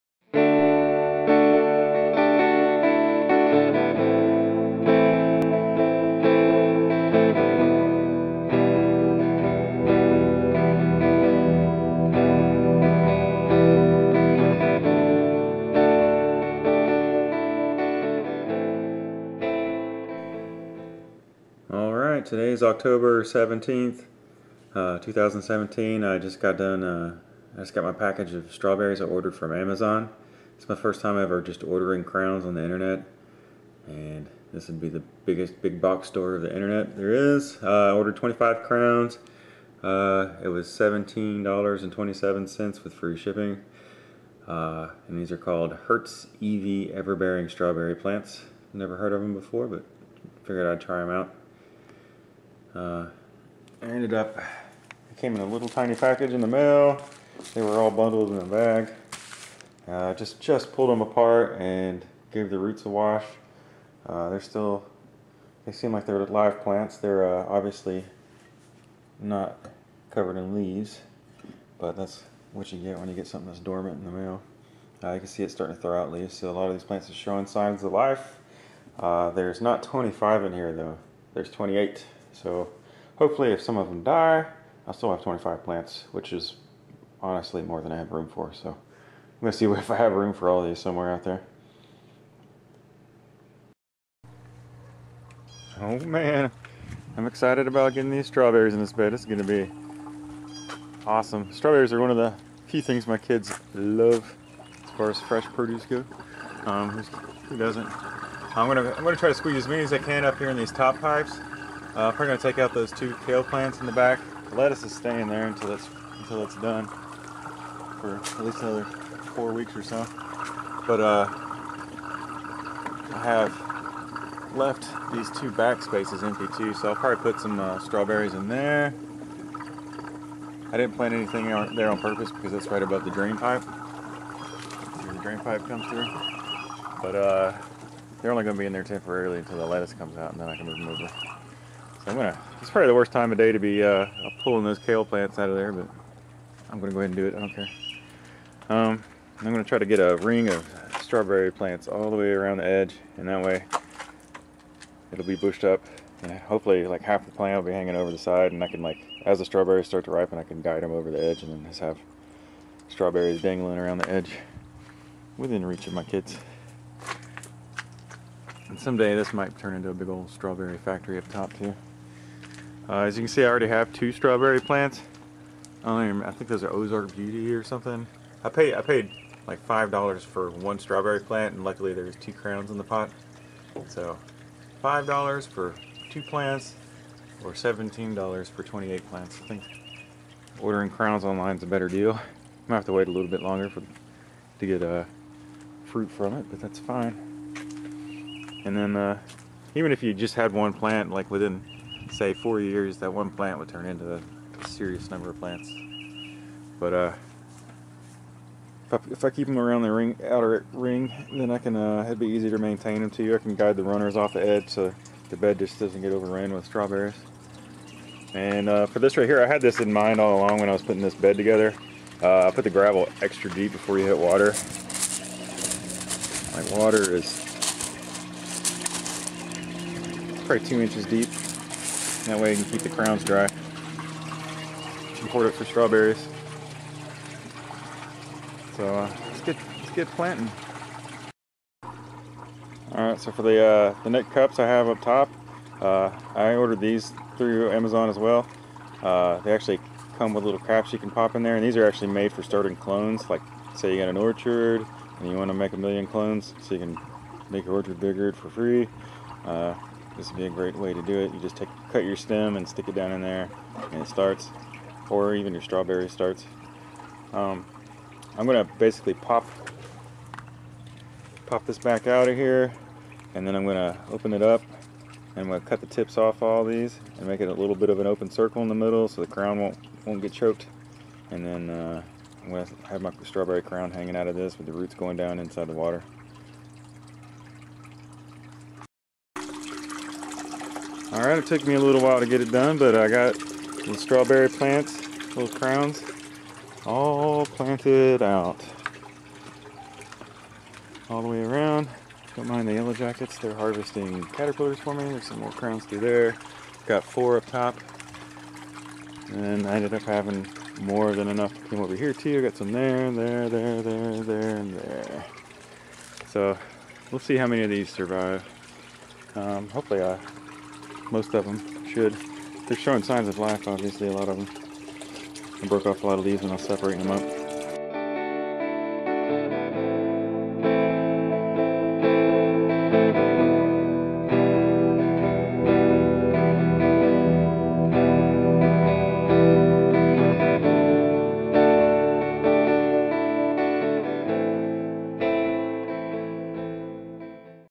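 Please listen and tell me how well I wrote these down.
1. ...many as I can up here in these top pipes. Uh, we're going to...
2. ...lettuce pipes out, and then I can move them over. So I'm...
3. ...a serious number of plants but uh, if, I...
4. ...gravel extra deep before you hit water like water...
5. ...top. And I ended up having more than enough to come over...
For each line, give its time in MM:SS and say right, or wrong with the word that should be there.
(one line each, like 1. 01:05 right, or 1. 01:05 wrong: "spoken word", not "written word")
1. 01:49 right
2. 02:19 wrong: "comes", not "pipes"
3. 03:24 right
4. 03:42 right
5. 05:07 right.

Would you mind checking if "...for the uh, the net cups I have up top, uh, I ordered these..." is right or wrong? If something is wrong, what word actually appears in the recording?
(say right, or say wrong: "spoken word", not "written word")
right.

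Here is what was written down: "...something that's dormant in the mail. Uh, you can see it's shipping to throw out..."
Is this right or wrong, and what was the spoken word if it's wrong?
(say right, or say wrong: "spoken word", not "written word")
wrong: "starting", not "shipping".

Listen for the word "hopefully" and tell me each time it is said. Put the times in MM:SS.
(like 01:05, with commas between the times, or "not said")
01:23, 02:36, 05:19.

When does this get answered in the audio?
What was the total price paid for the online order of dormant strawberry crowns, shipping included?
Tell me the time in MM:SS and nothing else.
00:40.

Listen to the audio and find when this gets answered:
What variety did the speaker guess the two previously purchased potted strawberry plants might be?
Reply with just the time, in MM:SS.
02:56.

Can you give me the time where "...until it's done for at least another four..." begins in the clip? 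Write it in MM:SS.
01:56.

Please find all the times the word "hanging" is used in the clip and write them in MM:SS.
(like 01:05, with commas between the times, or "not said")
02:37, 04:43.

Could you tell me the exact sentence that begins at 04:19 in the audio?
Uh, this would be a great way to do it.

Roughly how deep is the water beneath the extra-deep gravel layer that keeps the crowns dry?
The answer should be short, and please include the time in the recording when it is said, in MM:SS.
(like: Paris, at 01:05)
2 inches, at 03:50.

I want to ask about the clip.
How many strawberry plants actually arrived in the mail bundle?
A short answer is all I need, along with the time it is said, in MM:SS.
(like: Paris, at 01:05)
28, at 01:21.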